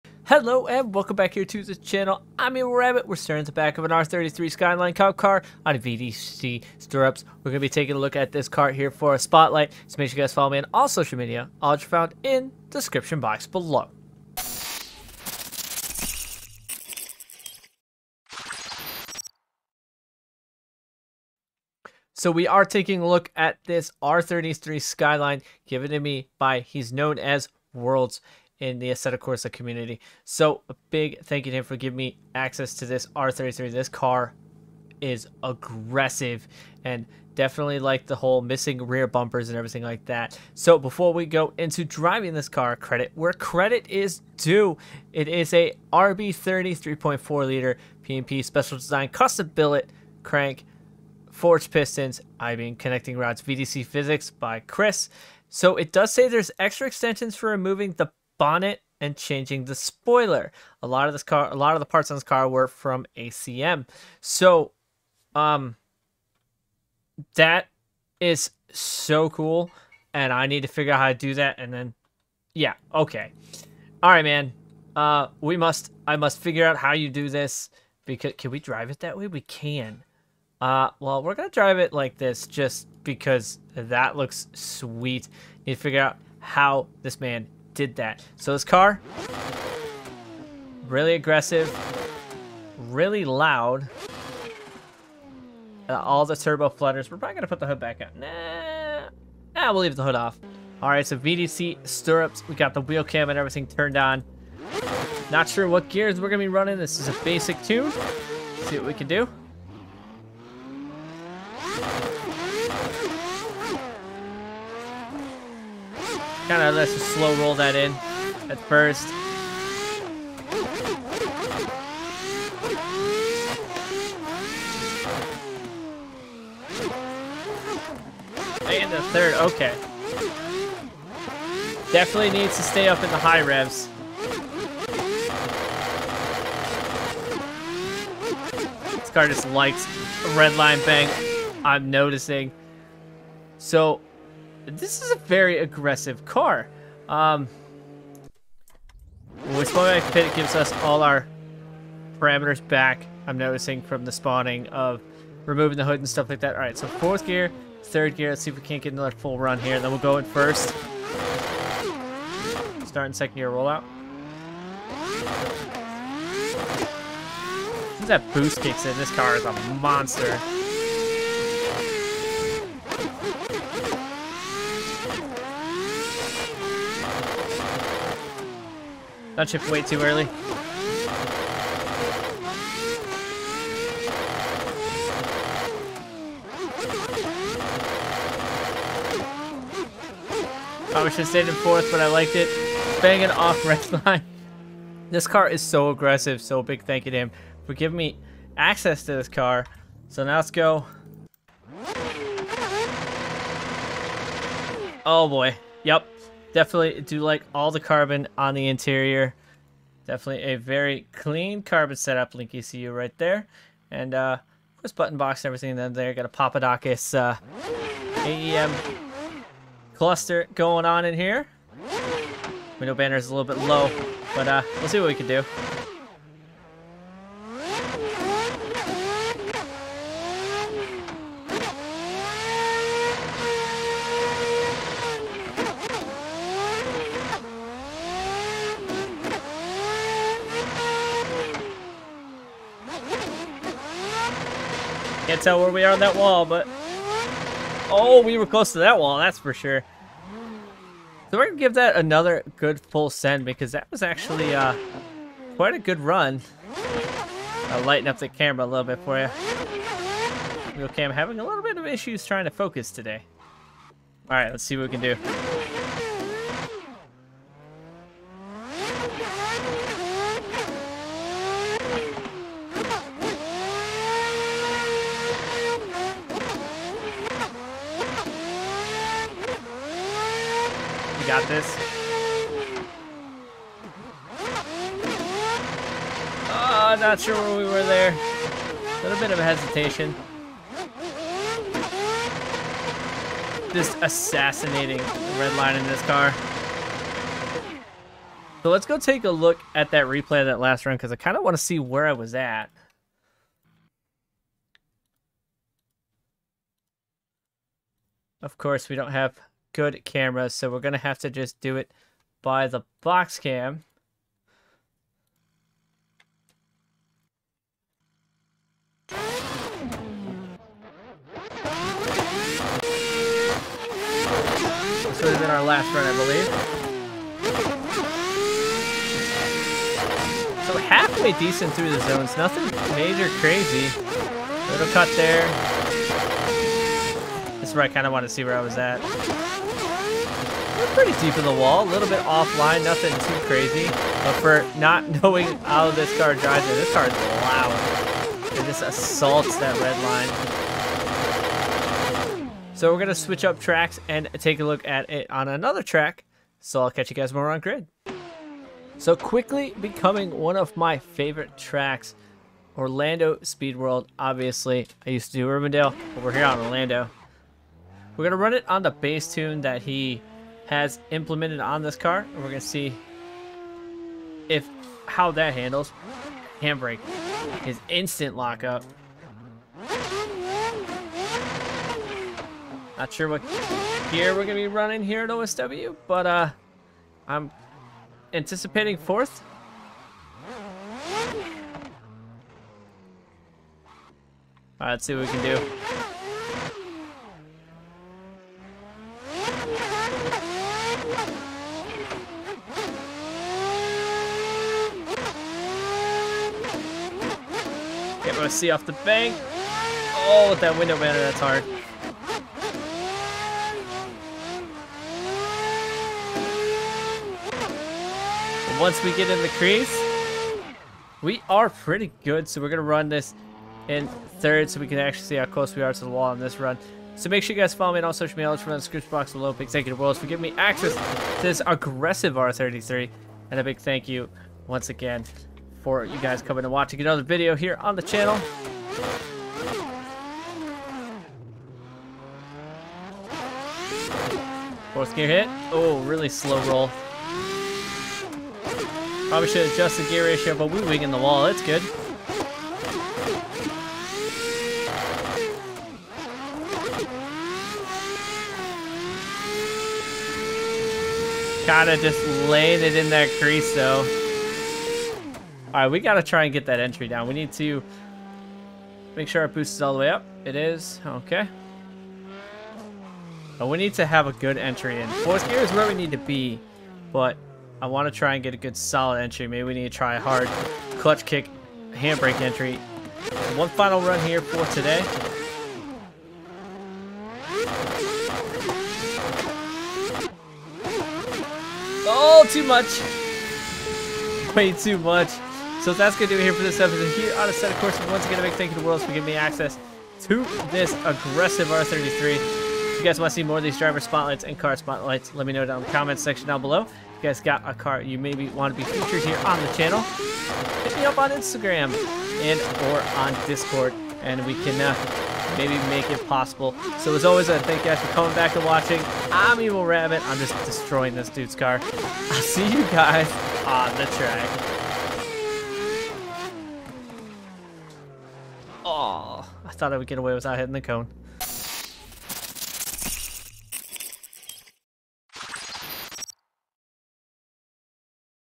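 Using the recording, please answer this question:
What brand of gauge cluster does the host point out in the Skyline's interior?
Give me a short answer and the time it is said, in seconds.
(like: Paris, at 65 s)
AEM, at 218 s.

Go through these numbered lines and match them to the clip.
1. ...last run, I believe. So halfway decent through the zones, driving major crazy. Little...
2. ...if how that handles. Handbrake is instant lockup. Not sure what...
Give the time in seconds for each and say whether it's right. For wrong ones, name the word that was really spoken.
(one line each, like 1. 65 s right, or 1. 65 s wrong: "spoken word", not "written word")
1. 325 s wrong: "nothing", not "driving"
2. 374 s right.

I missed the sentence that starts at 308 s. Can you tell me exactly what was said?
Of course, we don't have good camera, so we're going to have to just do it by the box cam.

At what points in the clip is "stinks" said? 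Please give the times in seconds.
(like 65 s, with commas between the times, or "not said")
not said.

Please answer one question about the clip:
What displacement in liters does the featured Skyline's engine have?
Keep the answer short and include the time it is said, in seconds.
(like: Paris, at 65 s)
3.4, at 46 s.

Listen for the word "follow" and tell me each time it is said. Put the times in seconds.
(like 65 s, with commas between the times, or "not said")
10 s, 427 s.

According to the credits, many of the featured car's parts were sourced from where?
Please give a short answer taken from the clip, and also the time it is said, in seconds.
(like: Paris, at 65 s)
ACM, at 63 s.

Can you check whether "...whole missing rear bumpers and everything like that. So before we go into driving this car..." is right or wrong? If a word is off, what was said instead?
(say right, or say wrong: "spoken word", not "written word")
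right.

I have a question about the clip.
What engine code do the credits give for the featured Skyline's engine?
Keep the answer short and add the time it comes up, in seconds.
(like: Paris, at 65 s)
RB30, at 45 s.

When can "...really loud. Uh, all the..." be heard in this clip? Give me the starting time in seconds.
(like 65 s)
92 s.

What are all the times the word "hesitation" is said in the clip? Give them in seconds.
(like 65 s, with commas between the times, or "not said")
289 s.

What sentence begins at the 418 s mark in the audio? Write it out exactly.
And once we get in the crease, we are pretty good.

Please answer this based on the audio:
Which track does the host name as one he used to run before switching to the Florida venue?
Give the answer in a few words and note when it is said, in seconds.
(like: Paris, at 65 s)
Urbandale, at 365 s.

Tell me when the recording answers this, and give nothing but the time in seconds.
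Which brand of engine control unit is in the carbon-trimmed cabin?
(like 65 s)
212 s.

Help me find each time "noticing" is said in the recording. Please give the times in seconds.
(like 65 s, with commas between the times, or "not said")
141 s, 153 s.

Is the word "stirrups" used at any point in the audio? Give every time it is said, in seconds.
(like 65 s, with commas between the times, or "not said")
6 s, 101 s.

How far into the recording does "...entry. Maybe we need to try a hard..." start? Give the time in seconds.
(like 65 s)
479 s.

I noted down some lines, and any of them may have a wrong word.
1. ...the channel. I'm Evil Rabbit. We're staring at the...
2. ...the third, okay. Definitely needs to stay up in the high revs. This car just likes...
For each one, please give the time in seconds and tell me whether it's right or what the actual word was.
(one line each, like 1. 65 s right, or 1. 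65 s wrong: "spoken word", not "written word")
1. 1 s right
2. 128 s right.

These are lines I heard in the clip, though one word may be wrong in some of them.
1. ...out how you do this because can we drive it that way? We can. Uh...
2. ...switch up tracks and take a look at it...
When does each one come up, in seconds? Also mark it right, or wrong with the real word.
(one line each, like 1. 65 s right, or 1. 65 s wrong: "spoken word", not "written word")
1. 76 s right
2. 353 s right.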